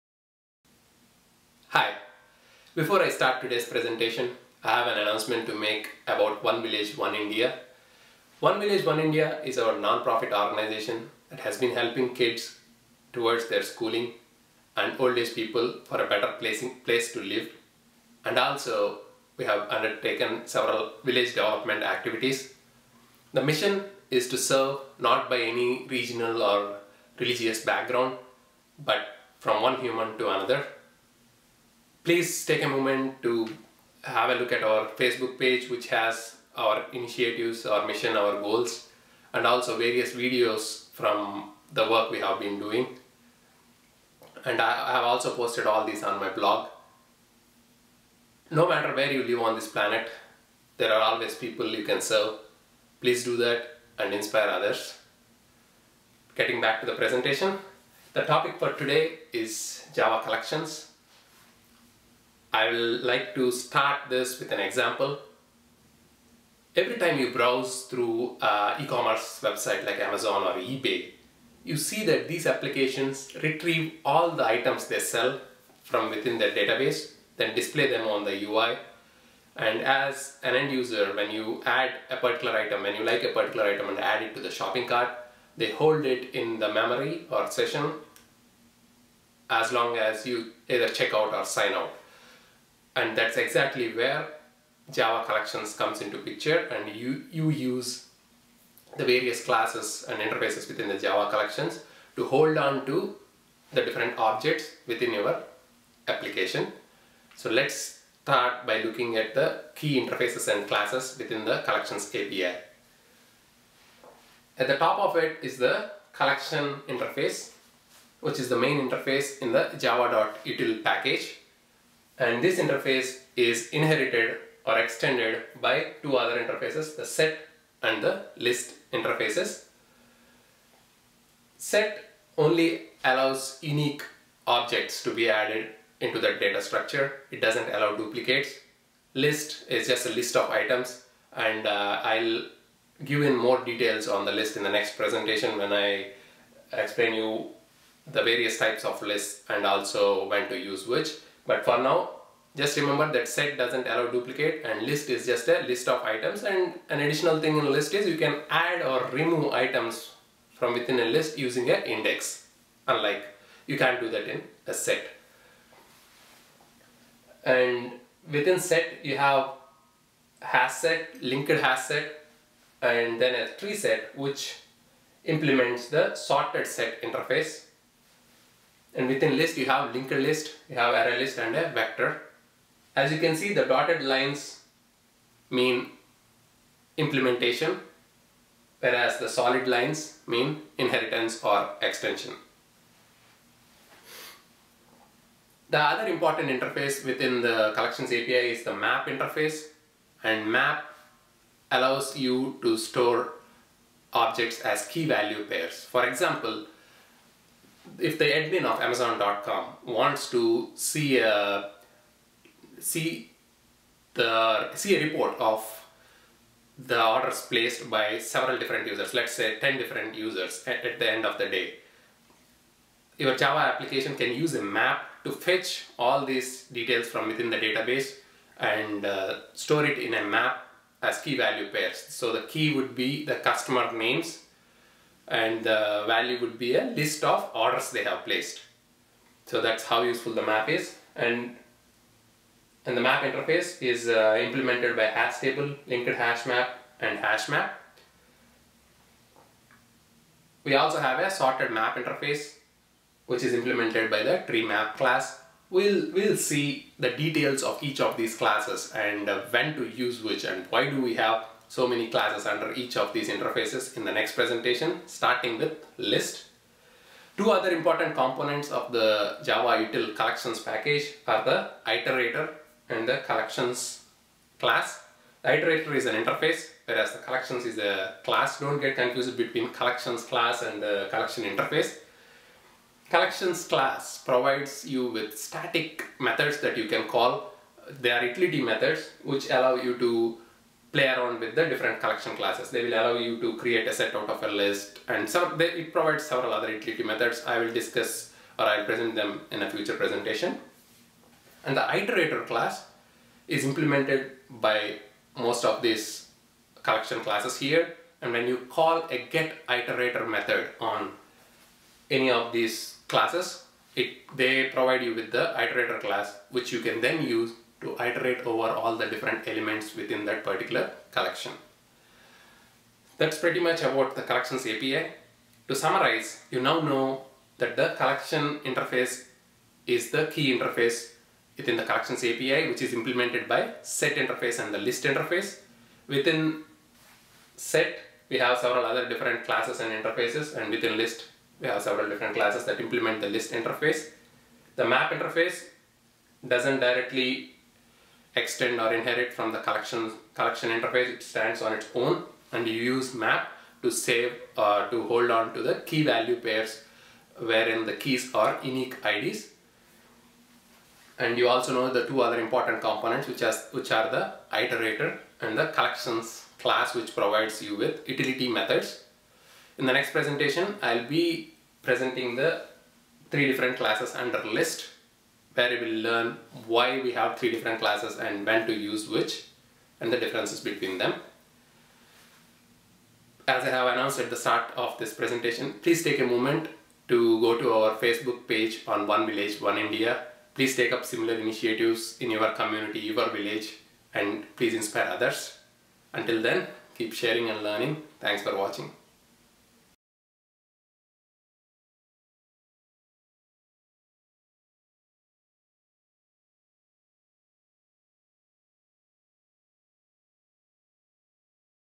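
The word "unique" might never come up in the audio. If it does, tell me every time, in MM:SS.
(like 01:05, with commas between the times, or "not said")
02:13, 05:58.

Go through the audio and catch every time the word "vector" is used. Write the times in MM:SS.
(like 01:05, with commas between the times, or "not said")
03:01.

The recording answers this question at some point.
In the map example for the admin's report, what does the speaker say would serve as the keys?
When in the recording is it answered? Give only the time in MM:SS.
03:53.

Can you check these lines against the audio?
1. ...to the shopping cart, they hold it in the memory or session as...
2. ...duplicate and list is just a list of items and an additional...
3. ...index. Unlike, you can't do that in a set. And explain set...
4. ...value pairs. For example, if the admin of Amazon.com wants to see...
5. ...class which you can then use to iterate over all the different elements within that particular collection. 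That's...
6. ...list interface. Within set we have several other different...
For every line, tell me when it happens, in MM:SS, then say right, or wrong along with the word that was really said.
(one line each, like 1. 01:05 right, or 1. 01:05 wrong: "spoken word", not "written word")
1. 01:24 right
2. 02:34 right
3. 02:41 wrong: "within", not "explain"
4. 03:25 right
5. 05:16 right
6. 05:34 right.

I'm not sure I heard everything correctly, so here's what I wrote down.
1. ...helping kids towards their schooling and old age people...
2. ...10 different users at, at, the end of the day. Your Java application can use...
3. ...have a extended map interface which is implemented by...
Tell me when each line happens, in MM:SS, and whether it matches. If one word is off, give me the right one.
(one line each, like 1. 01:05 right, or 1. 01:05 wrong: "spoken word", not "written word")
1. 00:11 right
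2. 03:39 right
3. 04:10 wrong: "sorted", not "extended".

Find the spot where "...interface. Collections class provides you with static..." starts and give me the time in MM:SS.
04:41.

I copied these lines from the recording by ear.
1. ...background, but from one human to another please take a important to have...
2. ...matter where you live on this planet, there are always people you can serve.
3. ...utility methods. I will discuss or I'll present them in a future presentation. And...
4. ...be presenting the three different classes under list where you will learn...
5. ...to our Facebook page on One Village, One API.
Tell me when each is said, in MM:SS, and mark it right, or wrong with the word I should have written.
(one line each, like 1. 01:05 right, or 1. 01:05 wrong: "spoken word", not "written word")
1. 00:27 wrong: "moment", not "important"
2. 00:48 right
3. 04:56 right
4. 06:11 right
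5. 06:27 wrong: "India", not "API".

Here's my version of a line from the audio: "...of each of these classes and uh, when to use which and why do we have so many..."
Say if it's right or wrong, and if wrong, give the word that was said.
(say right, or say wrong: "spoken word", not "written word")
right.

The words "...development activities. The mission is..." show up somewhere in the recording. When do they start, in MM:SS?
00:21.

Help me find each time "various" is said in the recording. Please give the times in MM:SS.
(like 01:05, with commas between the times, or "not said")
00:39, 01:39, 02:28.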